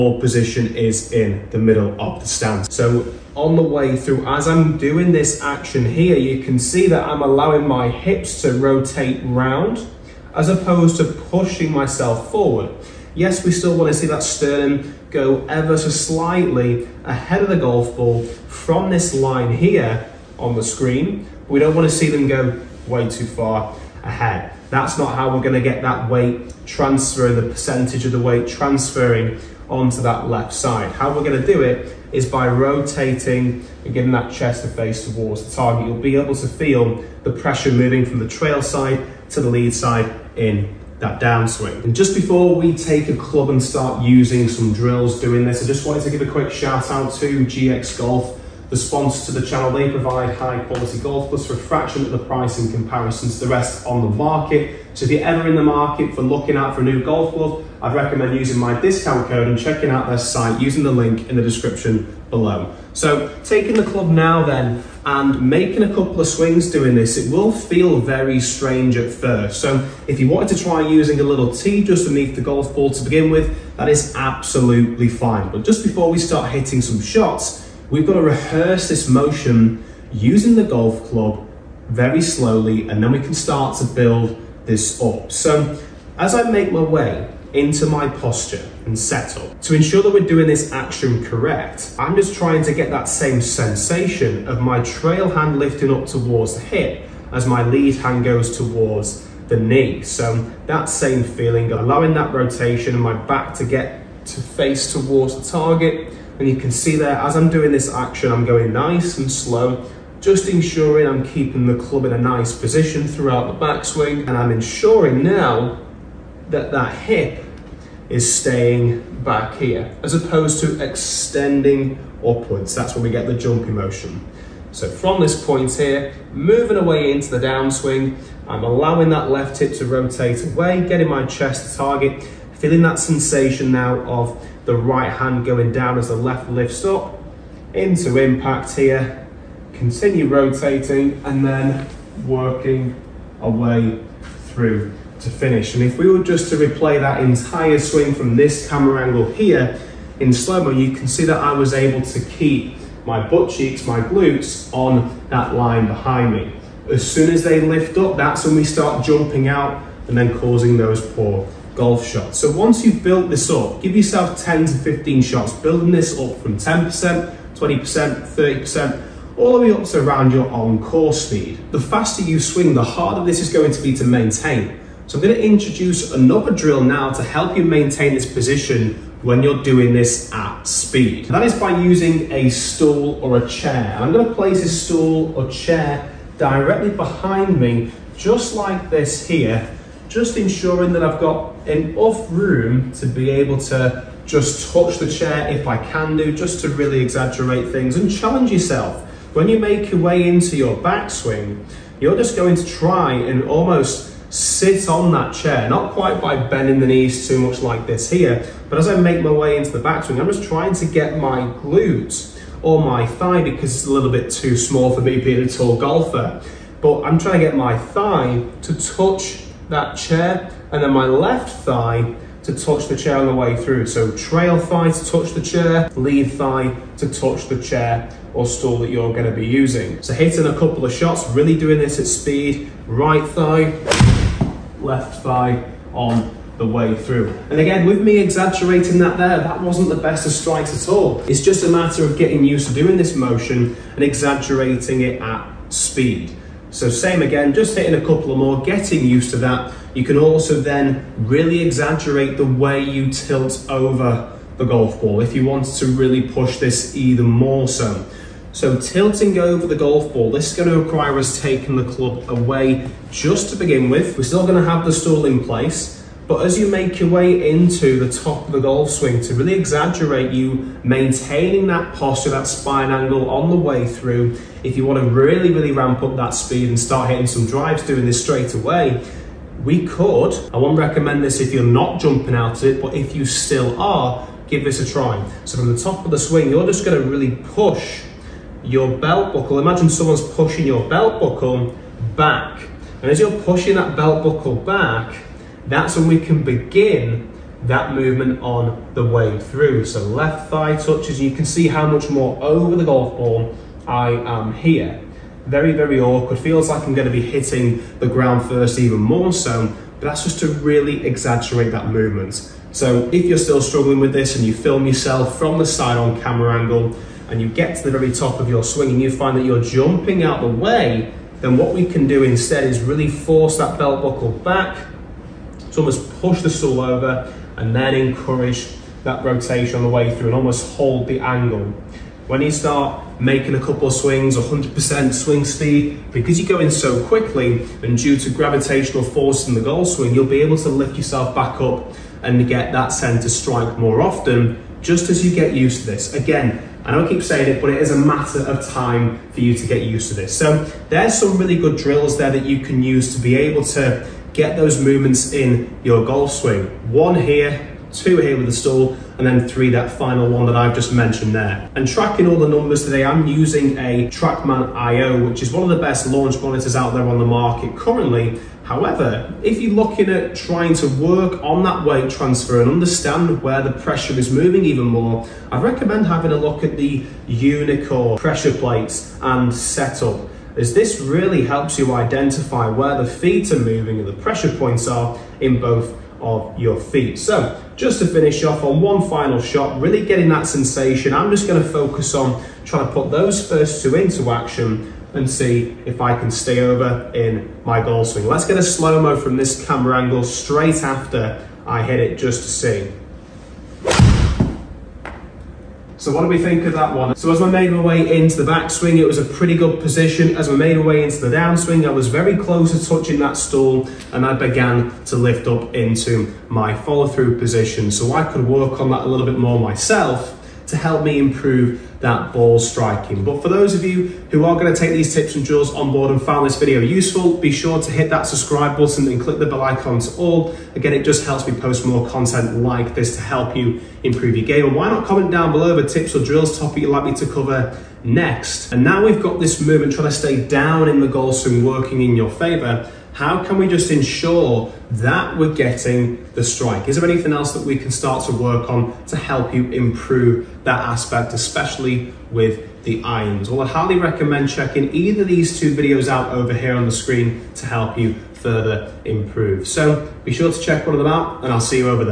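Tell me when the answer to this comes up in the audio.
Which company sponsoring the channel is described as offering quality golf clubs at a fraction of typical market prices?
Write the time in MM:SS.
00:47.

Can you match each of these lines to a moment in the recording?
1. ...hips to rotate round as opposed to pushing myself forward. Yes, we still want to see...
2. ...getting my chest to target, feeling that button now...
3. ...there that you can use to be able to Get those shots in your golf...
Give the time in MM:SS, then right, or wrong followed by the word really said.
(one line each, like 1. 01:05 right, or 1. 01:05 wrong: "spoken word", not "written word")
1. 00:07 right
2. 02:10 wrong: "sensation", not "button"
3. 05:52 wrong: "movements", not "shots".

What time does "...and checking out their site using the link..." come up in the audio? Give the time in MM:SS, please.
00:59.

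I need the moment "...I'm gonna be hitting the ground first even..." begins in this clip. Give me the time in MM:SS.
05:06.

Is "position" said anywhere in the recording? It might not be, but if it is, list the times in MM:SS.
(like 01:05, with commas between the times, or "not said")
00:00, 01:52, 02:58, 06:49, 06:57.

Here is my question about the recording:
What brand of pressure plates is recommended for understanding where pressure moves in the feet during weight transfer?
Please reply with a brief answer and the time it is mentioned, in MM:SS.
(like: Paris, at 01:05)
Unicore, at 06:17.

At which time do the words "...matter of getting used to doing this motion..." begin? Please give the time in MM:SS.
04:01.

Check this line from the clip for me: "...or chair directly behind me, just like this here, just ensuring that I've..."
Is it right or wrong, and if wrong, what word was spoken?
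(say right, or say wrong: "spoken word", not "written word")
right.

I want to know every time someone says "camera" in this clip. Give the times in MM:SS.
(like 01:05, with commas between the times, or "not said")
02:28, 05:16, 06:39.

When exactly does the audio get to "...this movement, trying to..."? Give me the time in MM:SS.
07:19.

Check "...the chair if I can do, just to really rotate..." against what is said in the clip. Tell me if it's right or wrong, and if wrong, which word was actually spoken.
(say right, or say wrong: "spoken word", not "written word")
wrong: "exaggerate", not "rotate".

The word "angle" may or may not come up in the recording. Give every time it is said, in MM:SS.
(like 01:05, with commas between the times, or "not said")
02:29, 04:32, 05:16, 05:31, 06:40.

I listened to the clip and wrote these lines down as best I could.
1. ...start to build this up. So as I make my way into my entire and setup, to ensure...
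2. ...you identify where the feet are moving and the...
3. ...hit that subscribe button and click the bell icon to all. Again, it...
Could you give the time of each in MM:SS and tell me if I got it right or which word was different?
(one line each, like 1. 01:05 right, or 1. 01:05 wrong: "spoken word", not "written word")
1. 01:23 wrong: "posture", not "entire"
2. 06:21 right
3. 07:07 right.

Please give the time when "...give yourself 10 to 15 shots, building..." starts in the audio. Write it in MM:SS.
02:43.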